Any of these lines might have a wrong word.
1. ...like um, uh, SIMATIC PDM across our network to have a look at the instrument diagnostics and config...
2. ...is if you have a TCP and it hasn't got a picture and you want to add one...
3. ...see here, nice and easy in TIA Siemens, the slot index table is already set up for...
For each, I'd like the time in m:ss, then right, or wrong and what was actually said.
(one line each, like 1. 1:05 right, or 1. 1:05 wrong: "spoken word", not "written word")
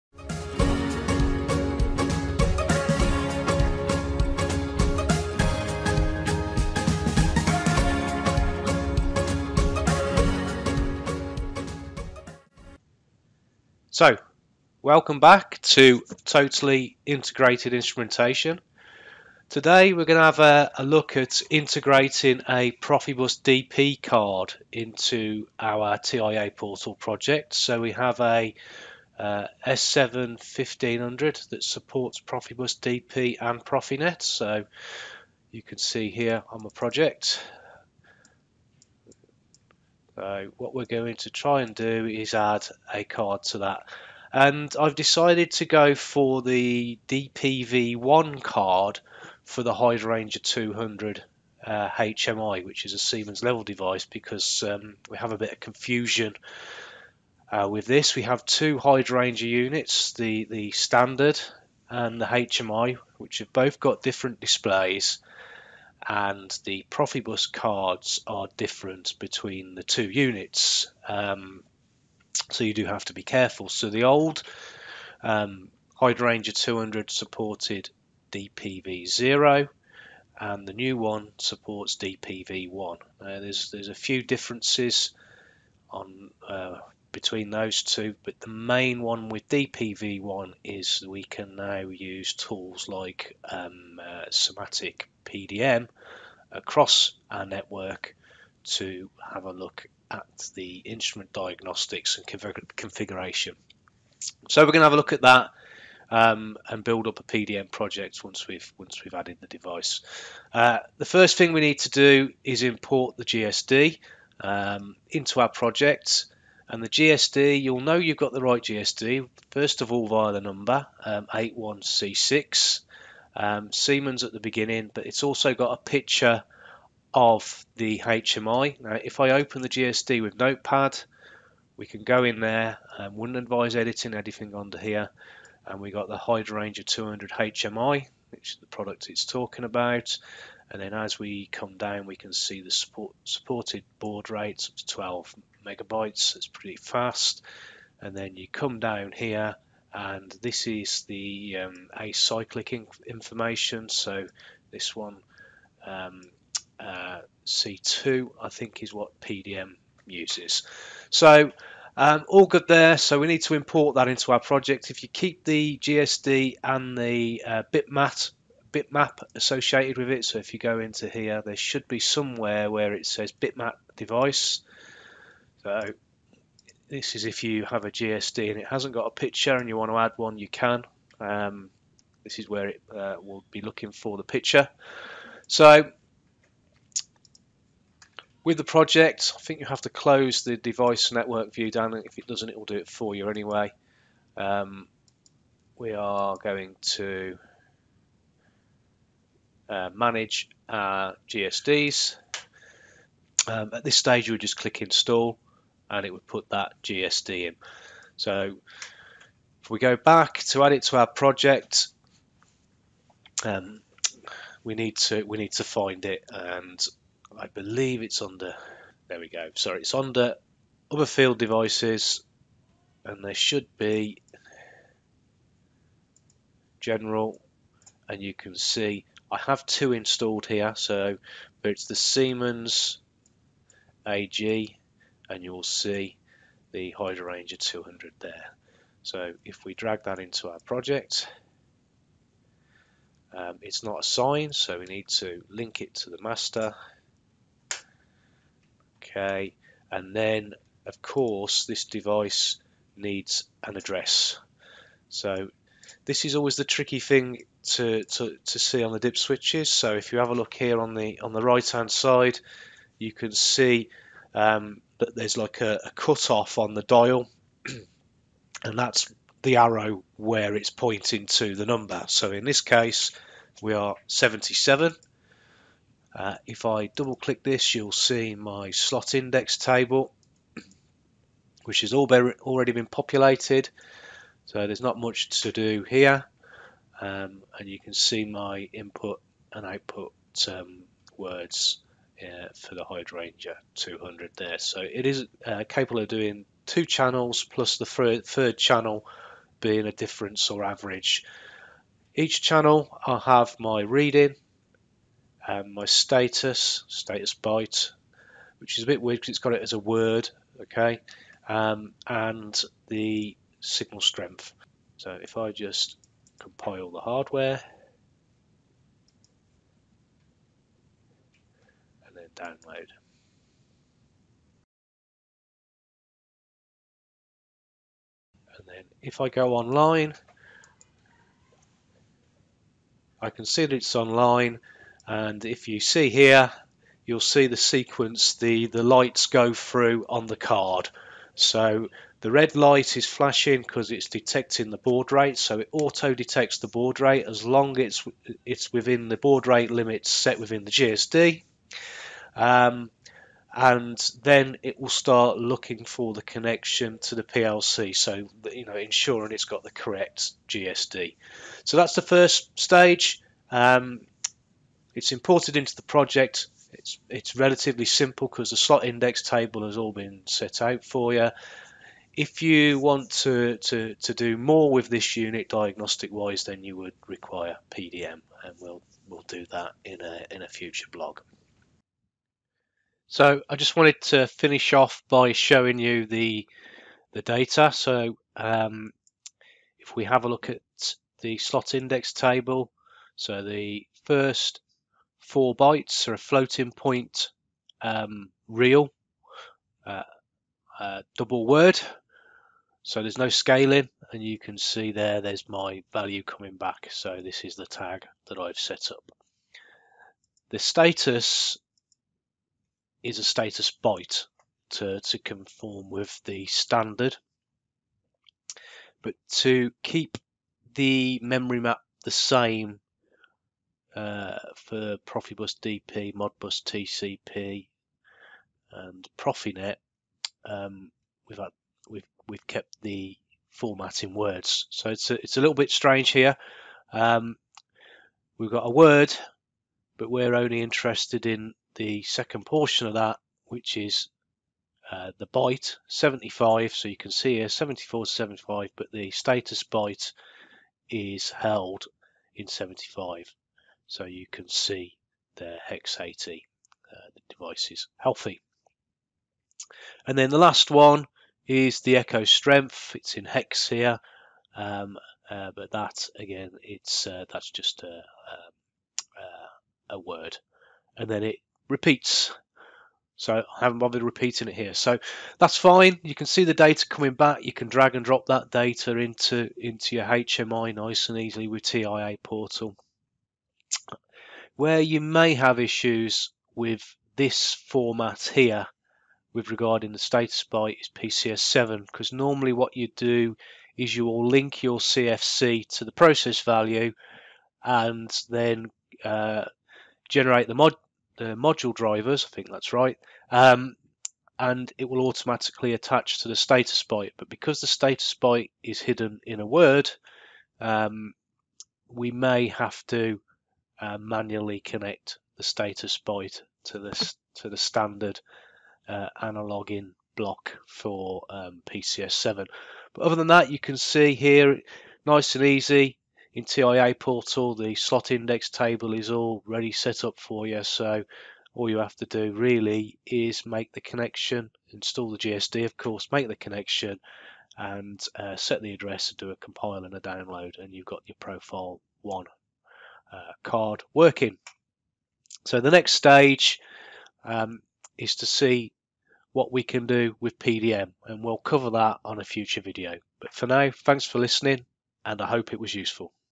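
1. 1:32 right
2. 2:57 wrong: "GSD", not "TCP"
3. 8:43 wrong: "Portal", not "Siemens".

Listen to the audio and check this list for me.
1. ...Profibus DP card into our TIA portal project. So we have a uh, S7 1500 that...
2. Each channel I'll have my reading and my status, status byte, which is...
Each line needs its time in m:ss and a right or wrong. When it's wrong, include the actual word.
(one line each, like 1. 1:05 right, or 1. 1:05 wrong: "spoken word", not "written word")
1. 0:22 right
2. 5:02 right.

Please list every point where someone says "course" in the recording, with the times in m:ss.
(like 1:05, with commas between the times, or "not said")
4:11, 8:55.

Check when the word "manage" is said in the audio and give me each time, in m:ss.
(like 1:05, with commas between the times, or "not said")
3:19.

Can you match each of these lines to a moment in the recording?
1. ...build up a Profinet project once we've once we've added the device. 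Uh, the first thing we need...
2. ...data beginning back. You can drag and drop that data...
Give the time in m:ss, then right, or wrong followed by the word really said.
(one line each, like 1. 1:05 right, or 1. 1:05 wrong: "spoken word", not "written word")
1. 1:46 wrong: "PDM", not "Profinet"
2. 7:56 wrong: "coming", not "beginning".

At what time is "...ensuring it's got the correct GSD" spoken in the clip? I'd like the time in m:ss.
5:58.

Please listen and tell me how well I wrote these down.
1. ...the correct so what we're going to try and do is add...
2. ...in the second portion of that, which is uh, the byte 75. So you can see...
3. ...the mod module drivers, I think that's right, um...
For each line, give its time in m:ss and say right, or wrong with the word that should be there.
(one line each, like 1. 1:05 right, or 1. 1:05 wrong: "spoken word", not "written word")
1. 0:36 wrong: "project", not "correct"
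2. 7:21 right
3. 8:20 right.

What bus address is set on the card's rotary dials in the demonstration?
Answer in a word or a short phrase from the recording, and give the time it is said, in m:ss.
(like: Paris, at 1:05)
77, at 4:34.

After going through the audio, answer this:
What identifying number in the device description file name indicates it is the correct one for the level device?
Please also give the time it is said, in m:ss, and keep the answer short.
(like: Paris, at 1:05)
81C6, at 2:01.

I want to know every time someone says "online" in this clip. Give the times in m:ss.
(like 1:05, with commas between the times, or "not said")
5:29, 5:33.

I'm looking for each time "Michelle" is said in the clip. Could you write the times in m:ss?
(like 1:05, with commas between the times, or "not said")
not said.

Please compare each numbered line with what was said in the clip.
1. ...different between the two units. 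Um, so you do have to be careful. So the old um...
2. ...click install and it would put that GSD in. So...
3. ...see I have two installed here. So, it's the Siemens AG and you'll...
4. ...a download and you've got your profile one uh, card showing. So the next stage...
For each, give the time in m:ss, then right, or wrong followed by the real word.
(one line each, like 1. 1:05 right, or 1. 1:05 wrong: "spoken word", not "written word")
1. 1:08 right
2. 3:24 right
3. 3:48 right
4. 8:59 wrong: "working", not "showing".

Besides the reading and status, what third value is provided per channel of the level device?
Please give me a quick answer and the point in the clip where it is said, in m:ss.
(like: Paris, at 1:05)
signal strength, at 5:13.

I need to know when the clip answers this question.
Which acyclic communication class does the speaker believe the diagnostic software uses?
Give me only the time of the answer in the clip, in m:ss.
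2:37.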